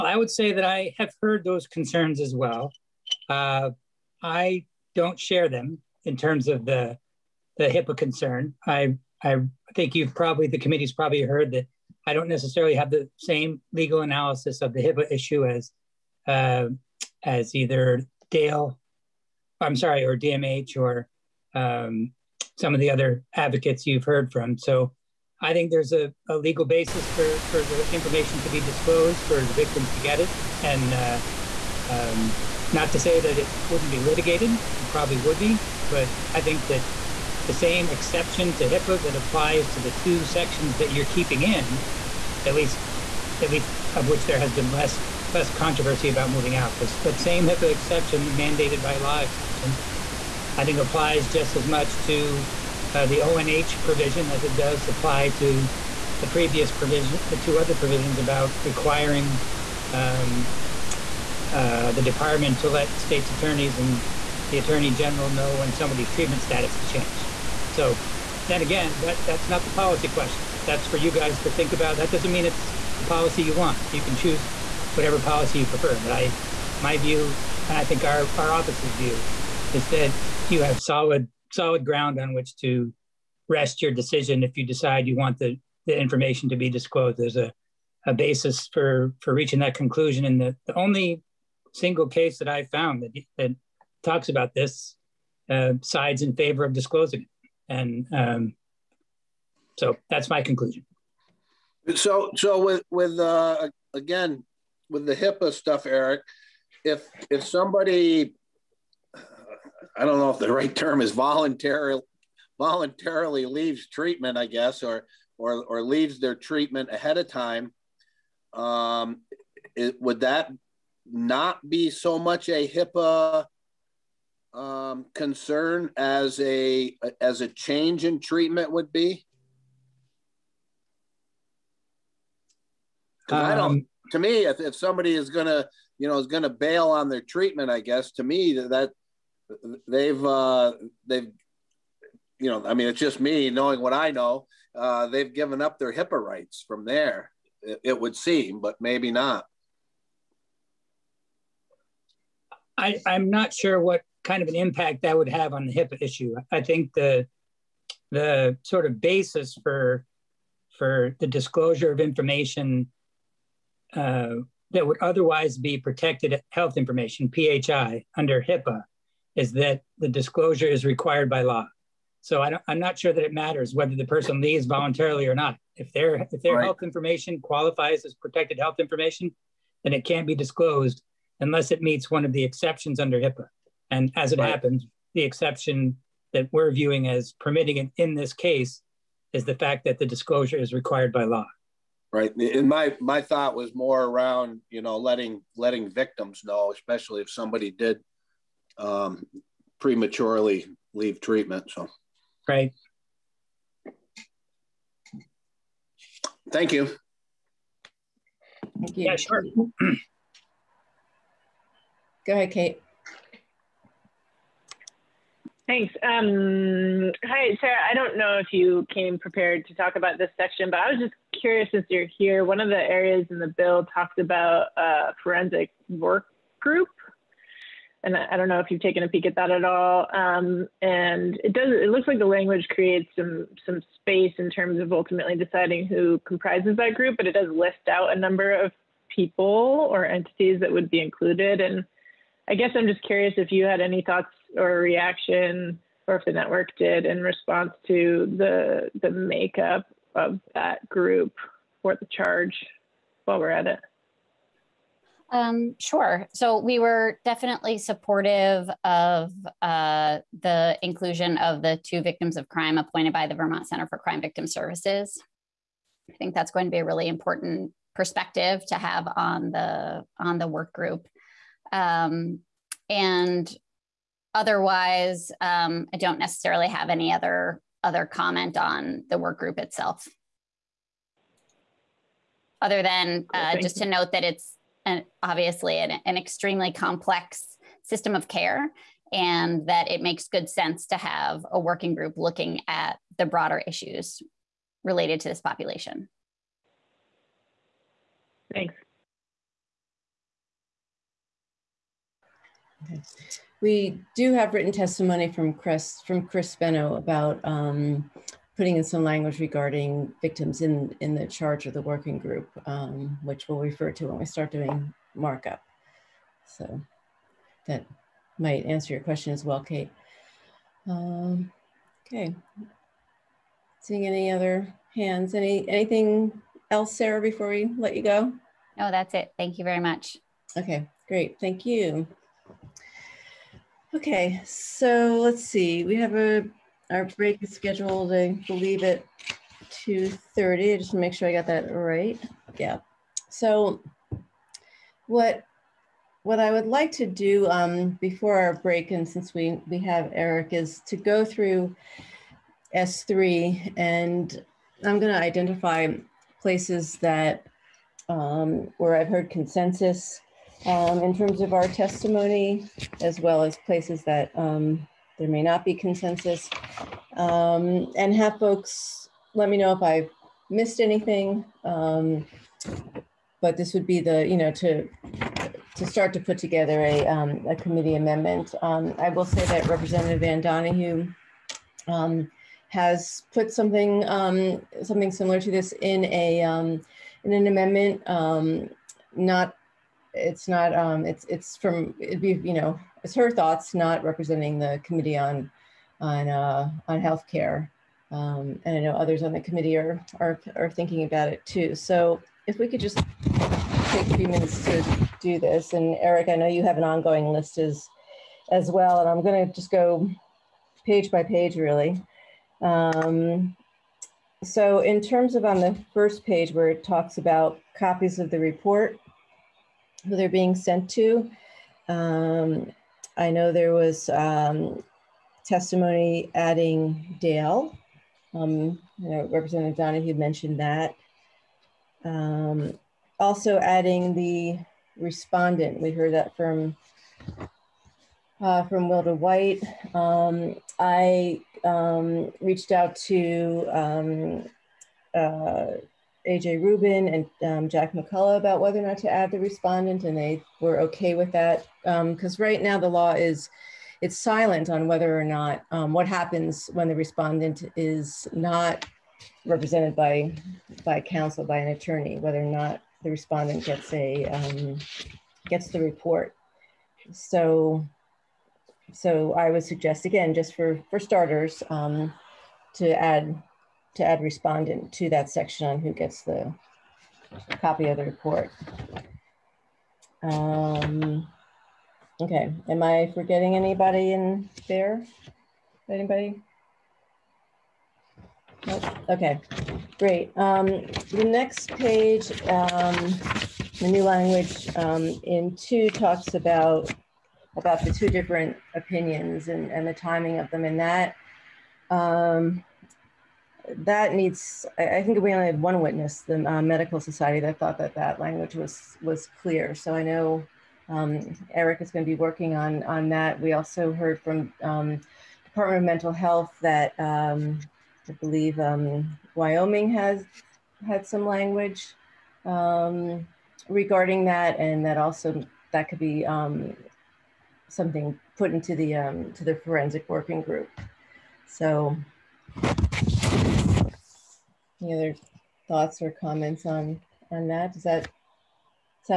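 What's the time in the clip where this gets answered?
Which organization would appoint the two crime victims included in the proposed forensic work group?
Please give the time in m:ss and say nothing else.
4:23.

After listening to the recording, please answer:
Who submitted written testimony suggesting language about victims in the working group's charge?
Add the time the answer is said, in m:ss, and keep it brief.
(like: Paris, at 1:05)
Chris Fenno, at 5:06.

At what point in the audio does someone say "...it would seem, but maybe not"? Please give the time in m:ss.
2:27.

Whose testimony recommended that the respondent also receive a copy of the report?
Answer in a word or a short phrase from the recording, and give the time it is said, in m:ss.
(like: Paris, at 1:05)
Wilda White, at 7:18.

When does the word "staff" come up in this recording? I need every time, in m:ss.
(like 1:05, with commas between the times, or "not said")
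not said.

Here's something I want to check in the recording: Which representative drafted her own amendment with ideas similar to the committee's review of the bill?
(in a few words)
Ann Donahue.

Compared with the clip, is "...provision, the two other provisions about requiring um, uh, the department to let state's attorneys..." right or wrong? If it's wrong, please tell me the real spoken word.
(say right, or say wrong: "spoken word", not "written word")
right.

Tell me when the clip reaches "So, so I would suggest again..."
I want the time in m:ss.
7:47.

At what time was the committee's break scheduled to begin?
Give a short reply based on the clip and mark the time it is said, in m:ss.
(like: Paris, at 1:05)
2:30, at 5:39.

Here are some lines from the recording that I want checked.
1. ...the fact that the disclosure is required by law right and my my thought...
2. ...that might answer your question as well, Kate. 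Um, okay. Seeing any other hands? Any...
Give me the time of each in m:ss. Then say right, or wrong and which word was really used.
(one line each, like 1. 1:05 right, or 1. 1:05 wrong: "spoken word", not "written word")
1. 3:09 right
2. 5:17 right.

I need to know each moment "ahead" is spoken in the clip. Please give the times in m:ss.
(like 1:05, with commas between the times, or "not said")
1:56, 3:32.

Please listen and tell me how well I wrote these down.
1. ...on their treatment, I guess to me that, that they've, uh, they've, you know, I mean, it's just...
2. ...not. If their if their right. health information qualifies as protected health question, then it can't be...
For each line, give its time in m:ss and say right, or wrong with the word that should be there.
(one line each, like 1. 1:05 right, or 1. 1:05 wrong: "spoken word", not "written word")
1. 2:16 right
2. 2:55 wrong: "information", not "question".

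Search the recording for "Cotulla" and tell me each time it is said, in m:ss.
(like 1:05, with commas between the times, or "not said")
not said.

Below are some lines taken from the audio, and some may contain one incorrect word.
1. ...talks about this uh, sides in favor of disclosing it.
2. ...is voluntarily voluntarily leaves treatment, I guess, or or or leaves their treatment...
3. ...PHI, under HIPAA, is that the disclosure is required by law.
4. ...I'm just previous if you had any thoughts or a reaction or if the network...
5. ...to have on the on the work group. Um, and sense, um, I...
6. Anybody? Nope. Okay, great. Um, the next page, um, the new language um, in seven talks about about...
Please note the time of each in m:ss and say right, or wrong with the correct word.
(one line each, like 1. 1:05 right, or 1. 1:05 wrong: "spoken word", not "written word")
1. 1:34 right
2. 1:51 right
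3. 2:47 right
4. 4:02 wrong: "curious", not "previous"
5. 4:28 wrong: "otherwise", not "sense"
6. 8:05 wrong: "two", not "seven".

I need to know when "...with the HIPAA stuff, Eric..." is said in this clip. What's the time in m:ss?
1:44.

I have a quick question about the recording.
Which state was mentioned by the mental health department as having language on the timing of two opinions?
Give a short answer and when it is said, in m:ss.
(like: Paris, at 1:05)
Wyoming, at 8:39.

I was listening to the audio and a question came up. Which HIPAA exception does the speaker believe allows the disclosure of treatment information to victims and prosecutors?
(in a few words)
mandated by law exception.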